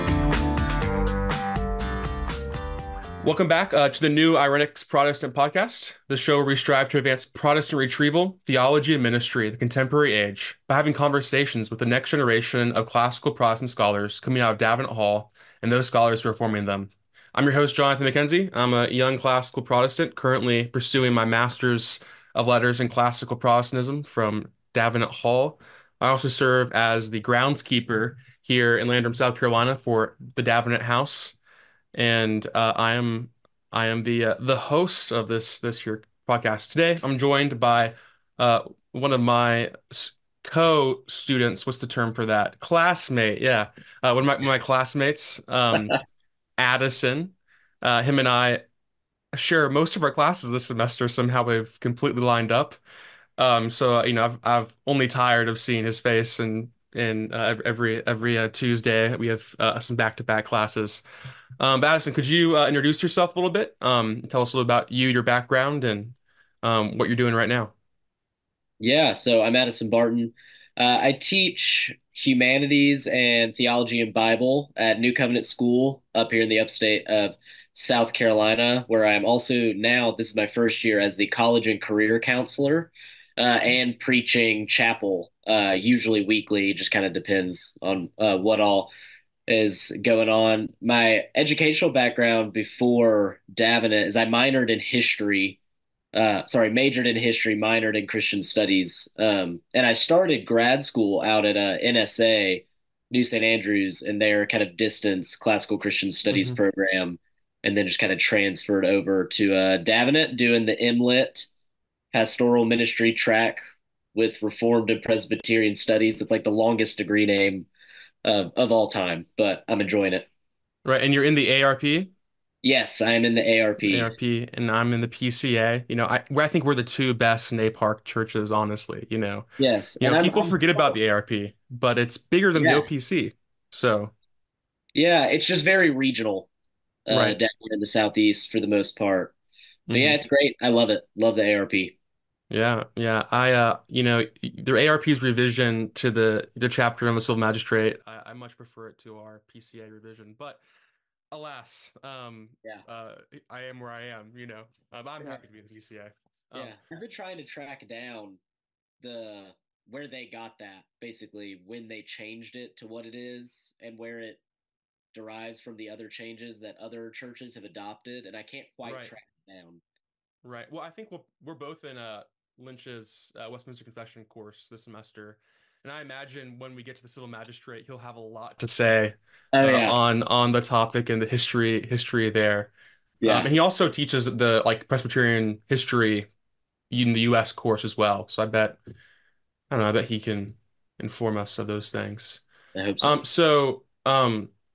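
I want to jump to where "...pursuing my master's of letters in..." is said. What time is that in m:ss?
0:20.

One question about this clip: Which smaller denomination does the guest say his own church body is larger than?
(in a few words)
OPC.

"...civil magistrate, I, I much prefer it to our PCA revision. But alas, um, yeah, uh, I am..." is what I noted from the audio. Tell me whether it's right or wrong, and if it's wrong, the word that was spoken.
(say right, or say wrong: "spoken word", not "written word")
right.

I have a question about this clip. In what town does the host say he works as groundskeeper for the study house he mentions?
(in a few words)
Landrum, South Carolina.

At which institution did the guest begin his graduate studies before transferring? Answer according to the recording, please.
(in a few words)
New St. Andrews.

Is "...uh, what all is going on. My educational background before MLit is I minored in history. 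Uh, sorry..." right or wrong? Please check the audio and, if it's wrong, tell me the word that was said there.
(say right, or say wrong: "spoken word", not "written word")
wrong: "Davenant", not "MLit".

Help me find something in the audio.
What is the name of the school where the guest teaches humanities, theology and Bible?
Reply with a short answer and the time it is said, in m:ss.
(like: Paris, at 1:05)
New Covenant School, at 1:14.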